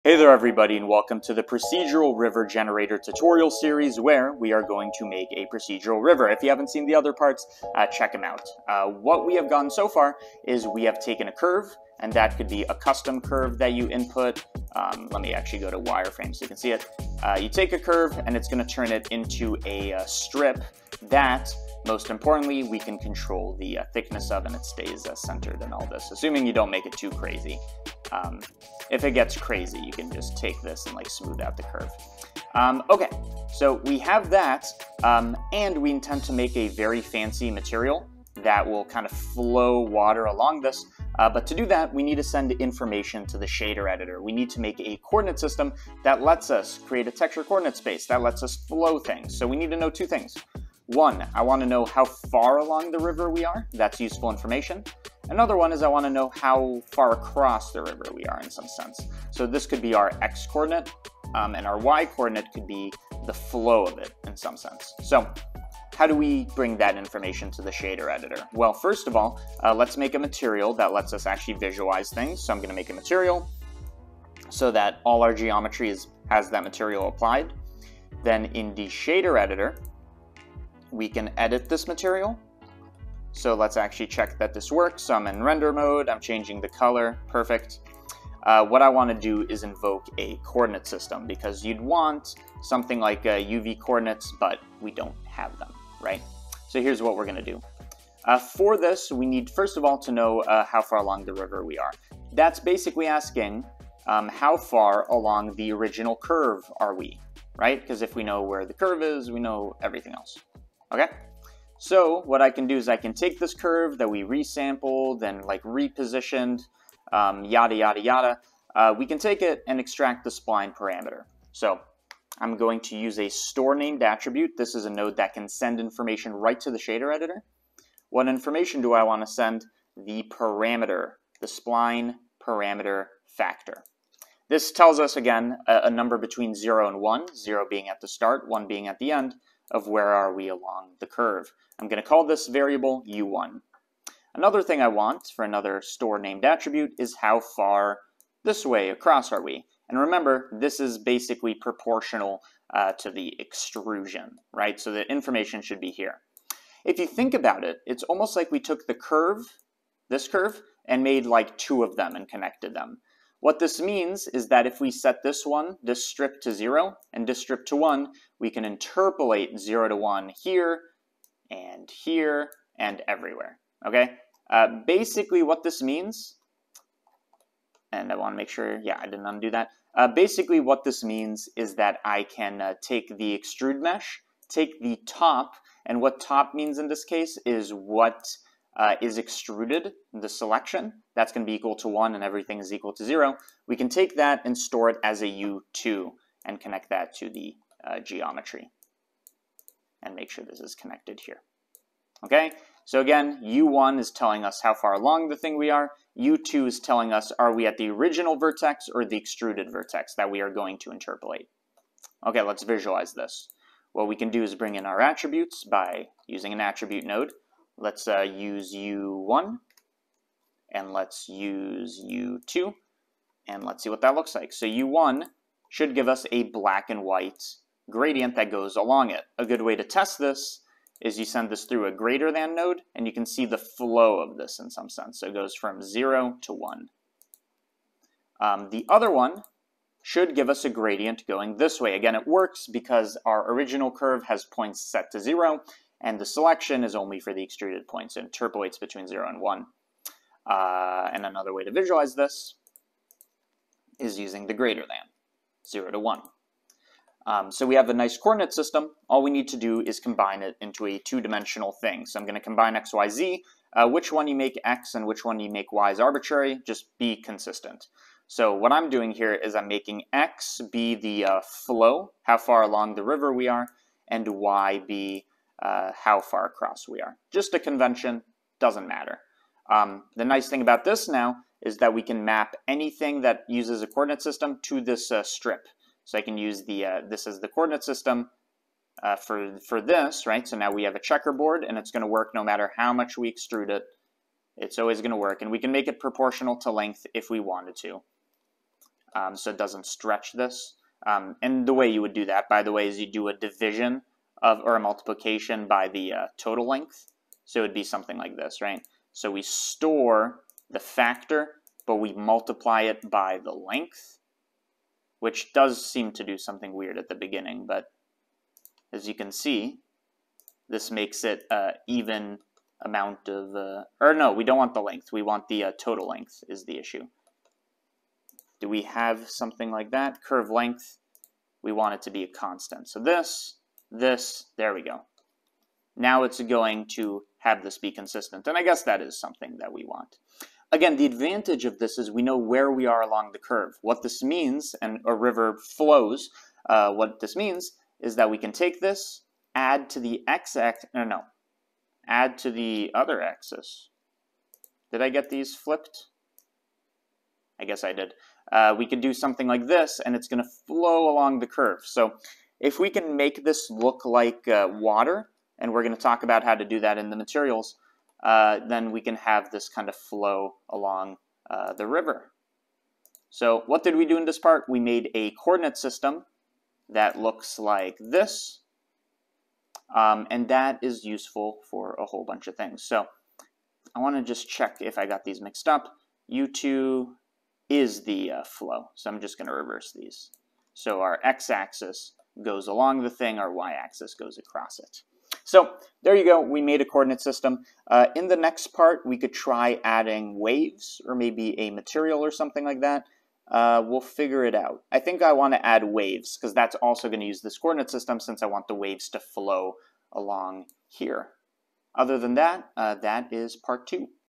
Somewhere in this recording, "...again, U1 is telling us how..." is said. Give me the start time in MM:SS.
03:23.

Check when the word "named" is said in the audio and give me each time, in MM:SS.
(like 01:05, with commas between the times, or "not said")
02:03, 02:26.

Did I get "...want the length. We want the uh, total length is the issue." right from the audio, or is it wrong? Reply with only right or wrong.
right.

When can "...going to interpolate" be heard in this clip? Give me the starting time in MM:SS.
03:30.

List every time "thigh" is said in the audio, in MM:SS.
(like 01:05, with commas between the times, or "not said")
not said.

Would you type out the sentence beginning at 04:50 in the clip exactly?
So now we have a checkerboard and it's going to work no matter how much we extrude it.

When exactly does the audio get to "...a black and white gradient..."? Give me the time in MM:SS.
03:46.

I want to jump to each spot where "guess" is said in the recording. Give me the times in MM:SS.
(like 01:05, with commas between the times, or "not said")
05:38, 05:57.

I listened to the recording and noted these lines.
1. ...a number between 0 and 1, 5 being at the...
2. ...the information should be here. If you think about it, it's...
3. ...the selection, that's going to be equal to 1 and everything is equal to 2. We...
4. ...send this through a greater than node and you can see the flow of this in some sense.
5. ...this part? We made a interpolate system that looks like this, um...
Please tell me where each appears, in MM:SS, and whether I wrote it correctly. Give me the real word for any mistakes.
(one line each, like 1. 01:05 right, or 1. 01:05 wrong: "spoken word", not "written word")
1. 02:15 wrong: "0", not "5"
2. 02:34 right
3. 03:10 wrong: "0", not "2"
4. 03:51 right
5. 06:14 wrong: "coordinate", not "interpolate".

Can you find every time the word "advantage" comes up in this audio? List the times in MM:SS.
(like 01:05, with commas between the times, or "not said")
05:41.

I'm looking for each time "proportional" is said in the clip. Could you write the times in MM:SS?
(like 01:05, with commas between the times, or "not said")
02:31, 04:55.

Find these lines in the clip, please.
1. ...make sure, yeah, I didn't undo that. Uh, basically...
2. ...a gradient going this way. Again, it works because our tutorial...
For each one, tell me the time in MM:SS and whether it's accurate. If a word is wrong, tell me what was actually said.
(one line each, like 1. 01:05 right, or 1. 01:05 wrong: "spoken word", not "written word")
1. 02:58 right
2. 04:00 wrong: "original", not "tutorial".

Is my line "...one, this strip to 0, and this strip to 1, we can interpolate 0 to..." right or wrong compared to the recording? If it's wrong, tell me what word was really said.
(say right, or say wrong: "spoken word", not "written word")
right.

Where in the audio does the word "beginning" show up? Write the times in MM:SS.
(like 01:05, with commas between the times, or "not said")
05:17.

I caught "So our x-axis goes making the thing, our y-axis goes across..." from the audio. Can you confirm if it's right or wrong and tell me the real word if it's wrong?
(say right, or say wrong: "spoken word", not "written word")
wrong: "along", not "making".